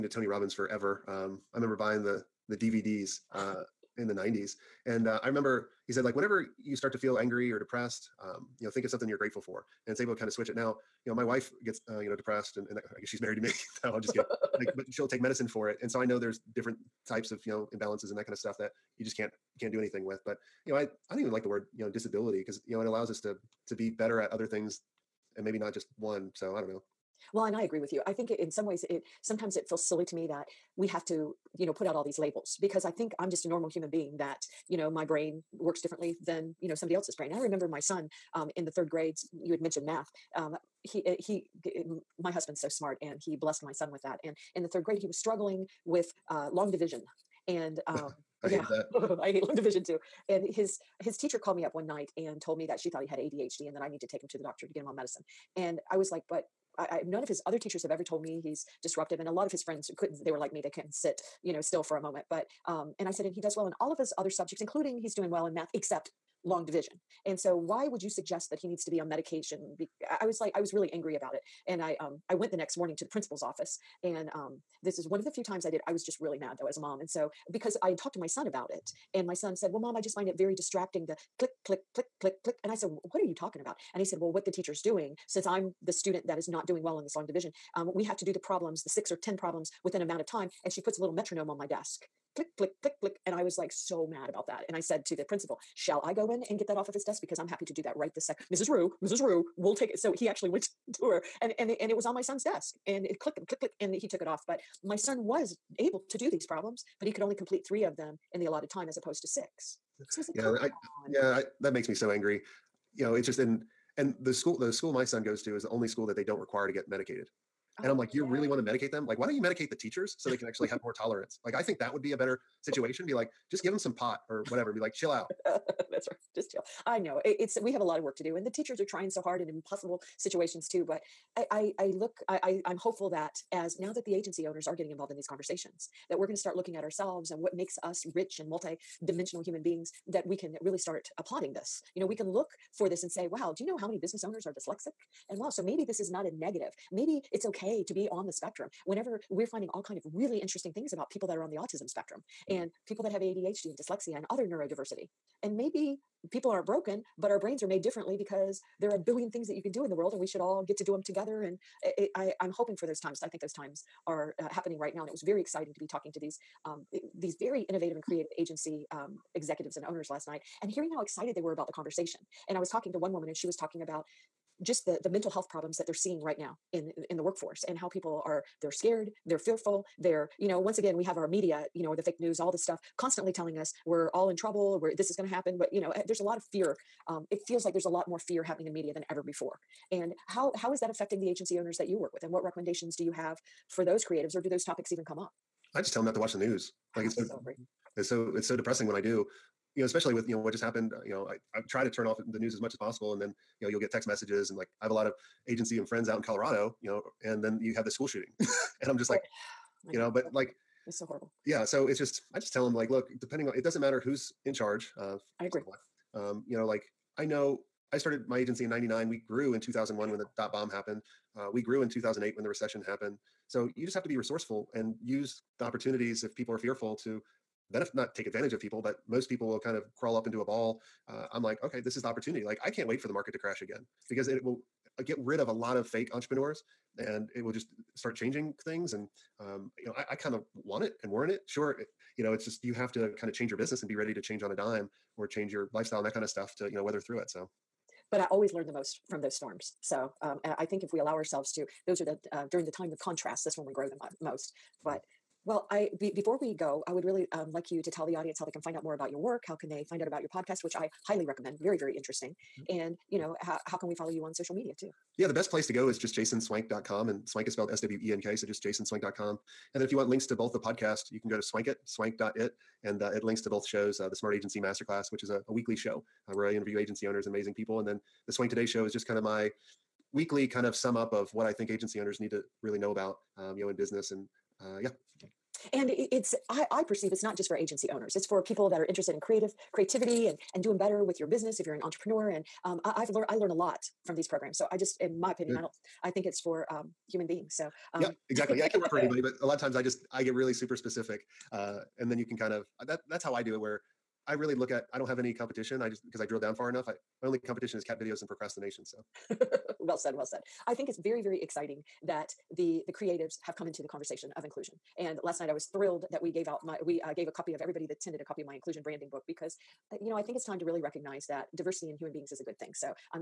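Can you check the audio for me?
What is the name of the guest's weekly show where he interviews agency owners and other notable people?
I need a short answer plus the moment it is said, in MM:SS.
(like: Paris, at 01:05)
Smart Agency Masterclass, at 04:34.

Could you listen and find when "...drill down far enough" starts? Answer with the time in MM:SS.
05:06.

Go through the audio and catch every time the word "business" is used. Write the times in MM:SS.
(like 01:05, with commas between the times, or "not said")
02:23, 04:03, 04:43, 04:51.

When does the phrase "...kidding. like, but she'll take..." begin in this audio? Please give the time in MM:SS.
00:14.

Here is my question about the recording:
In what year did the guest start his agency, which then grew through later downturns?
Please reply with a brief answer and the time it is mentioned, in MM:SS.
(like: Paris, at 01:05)
1999, at 03:38.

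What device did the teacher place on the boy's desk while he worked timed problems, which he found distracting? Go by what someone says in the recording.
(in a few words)
metronome.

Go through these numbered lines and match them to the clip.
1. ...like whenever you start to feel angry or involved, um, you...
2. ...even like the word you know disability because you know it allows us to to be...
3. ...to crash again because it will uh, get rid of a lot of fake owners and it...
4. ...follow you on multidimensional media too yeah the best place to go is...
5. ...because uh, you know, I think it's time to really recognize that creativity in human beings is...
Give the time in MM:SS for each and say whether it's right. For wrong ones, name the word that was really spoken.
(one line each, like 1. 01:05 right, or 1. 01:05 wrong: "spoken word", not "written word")
1. 00:06 wrong: "depressed", not "involved"
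2. 00:21 right
3. 03:53 wrong: "entrepreneurs", not "owners"
4. 04:23 wrong: "social", not "multidimensional"
5. 05:19 wrong: "diversity", not "creativity".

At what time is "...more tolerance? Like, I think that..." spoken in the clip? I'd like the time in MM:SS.
02:00.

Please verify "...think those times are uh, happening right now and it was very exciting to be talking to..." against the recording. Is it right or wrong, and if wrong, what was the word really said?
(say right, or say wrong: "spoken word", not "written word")
right.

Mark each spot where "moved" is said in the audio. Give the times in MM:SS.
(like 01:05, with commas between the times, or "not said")
not said.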